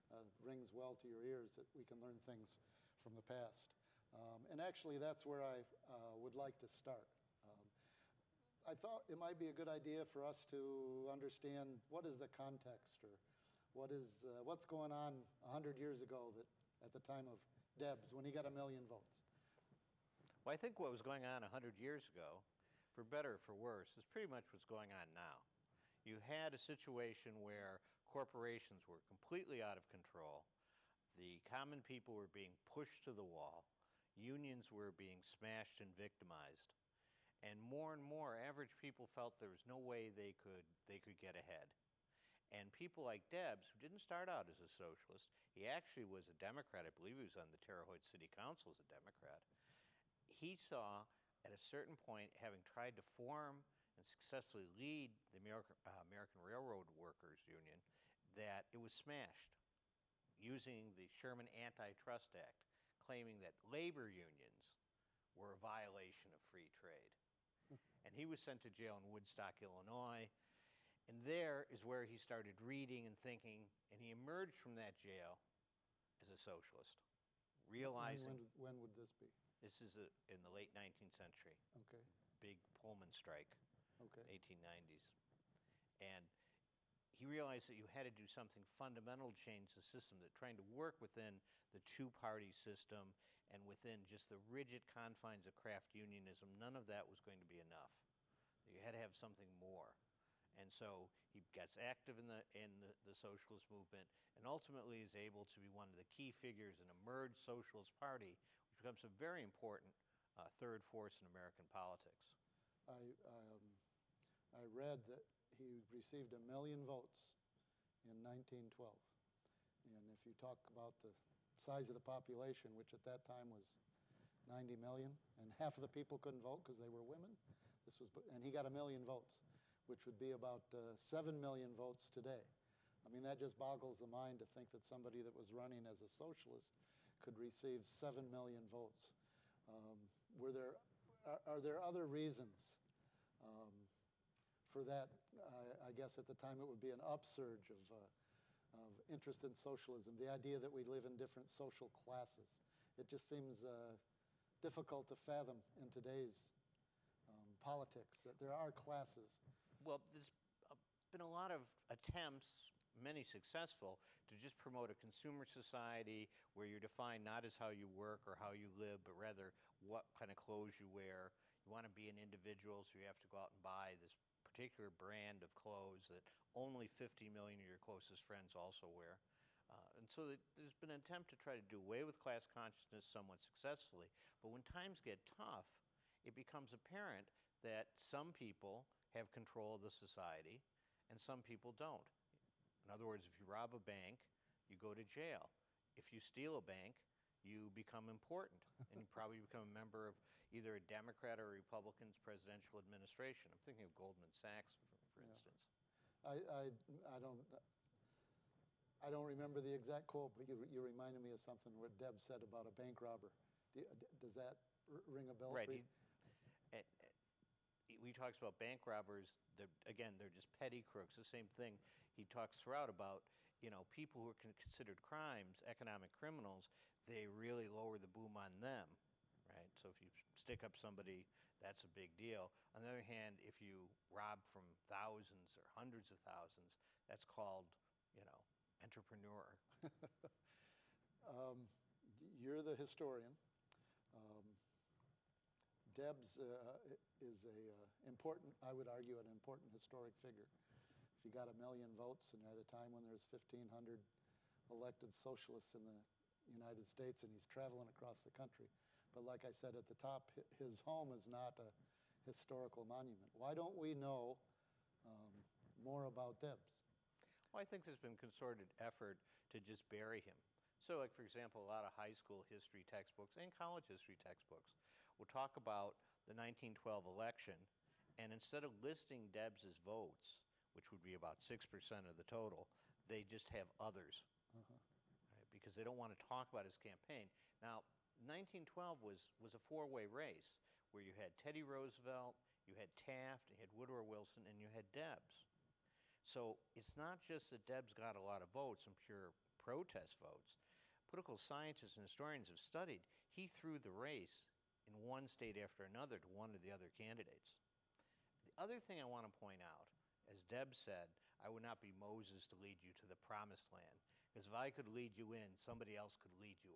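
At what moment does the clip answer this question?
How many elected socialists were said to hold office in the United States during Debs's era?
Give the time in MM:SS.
04:13.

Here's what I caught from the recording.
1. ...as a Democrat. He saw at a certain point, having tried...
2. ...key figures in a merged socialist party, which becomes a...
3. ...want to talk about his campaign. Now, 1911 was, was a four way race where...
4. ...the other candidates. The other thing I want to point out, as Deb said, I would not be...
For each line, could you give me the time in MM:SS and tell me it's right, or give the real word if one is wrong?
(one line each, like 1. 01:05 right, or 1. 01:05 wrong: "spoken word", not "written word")
1. 00:48 right
2. 01:46 right
3. 04:45 wrong: "1912", not "1911"
4. 05:06 right.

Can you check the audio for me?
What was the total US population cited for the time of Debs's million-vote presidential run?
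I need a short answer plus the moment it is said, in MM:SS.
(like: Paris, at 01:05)
90 million, at 02:04.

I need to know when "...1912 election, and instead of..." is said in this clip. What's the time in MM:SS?
04:36.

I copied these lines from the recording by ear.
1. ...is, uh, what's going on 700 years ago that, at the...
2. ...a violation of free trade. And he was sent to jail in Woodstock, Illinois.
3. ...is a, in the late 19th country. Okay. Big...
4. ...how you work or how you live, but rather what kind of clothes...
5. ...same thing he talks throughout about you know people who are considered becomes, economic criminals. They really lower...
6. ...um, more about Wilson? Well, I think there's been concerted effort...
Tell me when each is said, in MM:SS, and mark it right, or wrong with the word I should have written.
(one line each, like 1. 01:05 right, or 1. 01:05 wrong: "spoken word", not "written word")
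1. 00:13 wrong: "100", not "700"
2. 01:05 right
3. 01:19 wrong: "century", not "country"
4. 02:47 right
5. 03:41 wrong: "crimes", not "becomes"
6. 04:25 wrong: "Debs", not "Wilson".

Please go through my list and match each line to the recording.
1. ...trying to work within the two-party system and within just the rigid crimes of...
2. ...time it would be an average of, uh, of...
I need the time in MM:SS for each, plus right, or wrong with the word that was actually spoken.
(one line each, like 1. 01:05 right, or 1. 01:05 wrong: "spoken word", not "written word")
1. 01:30 wrong: "confines", not "crimes"
2. 02:26 wrong: "upsurge", not "average".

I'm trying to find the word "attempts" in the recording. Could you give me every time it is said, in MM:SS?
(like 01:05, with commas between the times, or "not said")
02:41, 03:01.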